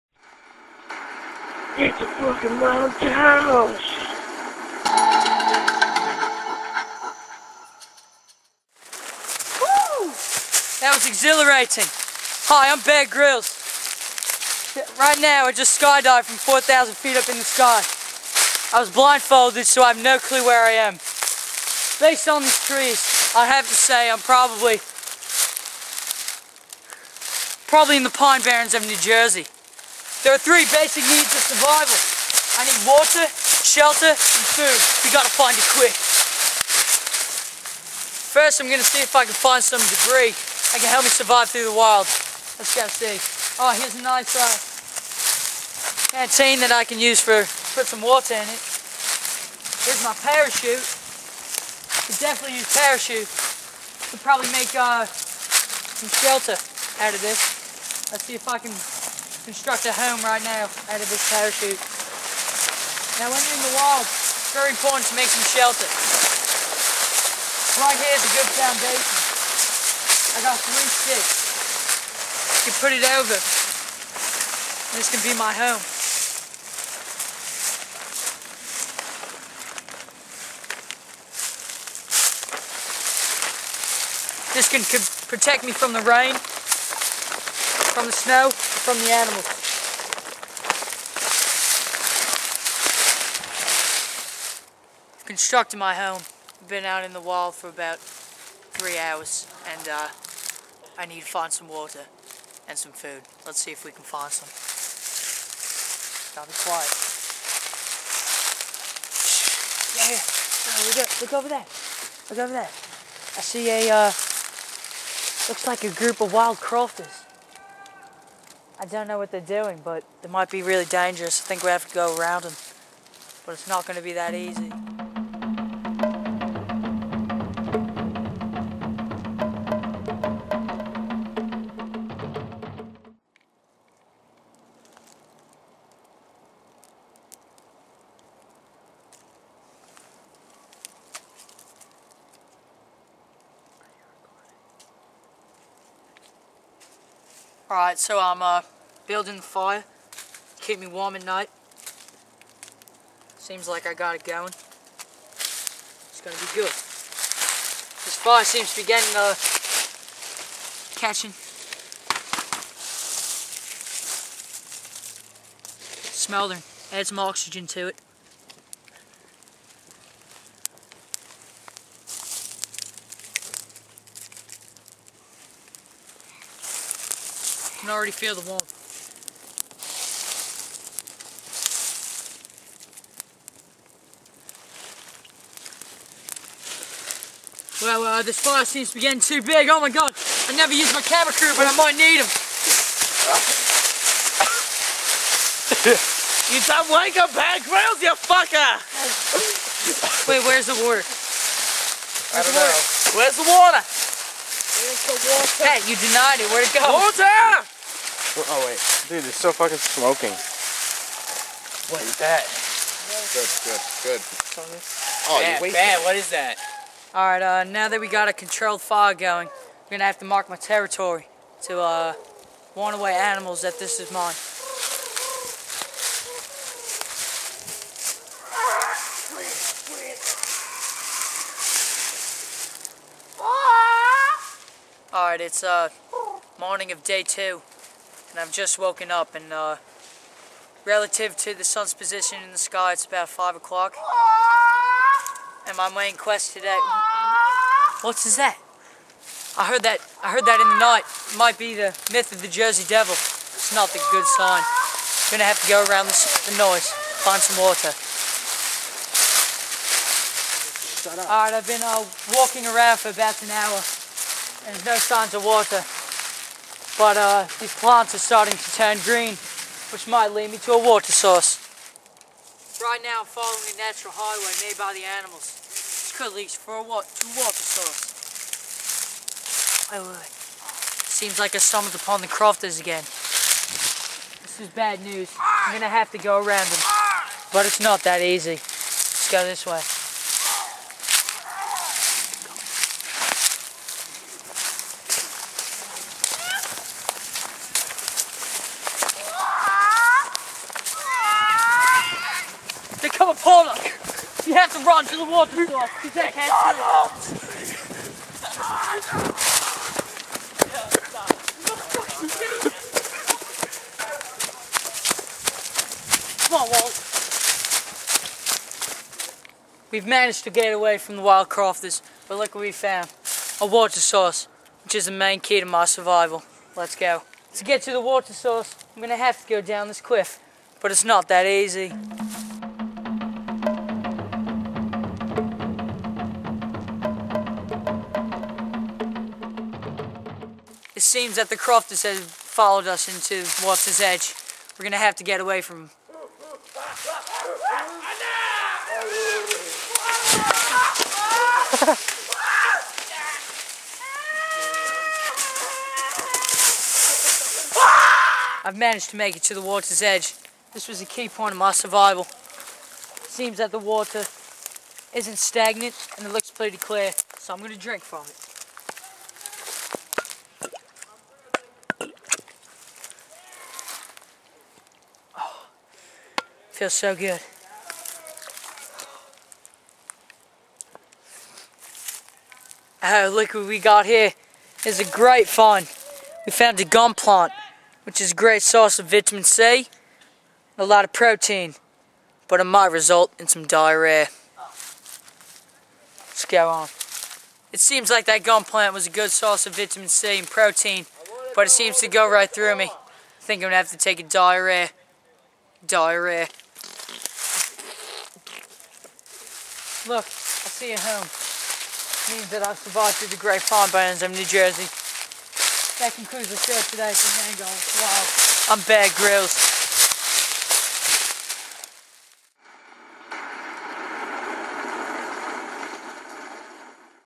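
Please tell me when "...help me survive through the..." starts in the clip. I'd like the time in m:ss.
0:40.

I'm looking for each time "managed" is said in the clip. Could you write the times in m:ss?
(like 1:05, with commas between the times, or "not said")
5:20, 5:58.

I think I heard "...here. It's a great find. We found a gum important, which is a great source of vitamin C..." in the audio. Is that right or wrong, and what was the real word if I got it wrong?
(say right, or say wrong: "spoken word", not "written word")
wrong: "plant", not "important".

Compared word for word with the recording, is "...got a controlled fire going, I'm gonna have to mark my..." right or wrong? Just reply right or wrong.
right.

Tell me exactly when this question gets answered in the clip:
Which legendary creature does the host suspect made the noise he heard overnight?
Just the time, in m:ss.
4:12.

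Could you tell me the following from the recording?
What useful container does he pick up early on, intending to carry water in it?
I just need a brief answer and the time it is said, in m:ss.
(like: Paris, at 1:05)
canteen, at 0:46.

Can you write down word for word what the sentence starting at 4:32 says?
Right now following a natural highway made by the animals.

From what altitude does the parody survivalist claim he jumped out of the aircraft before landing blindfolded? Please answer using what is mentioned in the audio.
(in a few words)
4,000 feet.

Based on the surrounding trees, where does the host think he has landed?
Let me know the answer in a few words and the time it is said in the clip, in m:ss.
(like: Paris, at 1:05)
Pine Barrens of New Jersey, at 0:28.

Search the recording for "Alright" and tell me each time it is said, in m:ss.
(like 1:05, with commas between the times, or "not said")
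2:27, 4:21.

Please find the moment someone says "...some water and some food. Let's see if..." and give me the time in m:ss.
1:41.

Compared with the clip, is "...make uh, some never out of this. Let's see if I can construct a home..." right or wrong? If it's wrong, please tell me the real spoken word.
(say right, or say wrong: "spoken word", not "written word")
wrong: "shelter", not "never".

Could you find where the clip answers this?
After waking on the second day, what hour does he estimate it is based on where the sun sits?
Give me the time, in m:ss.
4:03.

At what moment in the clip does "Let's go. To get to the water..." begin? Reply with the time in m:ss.
5:26.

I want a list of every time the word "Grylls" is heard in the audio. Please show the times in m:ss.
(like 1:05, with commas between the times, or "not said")
0:13.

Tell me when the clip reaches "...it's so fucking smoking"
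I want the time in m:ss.
3:29.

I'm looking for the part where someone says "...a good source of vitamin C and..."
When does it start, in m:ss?
6:39.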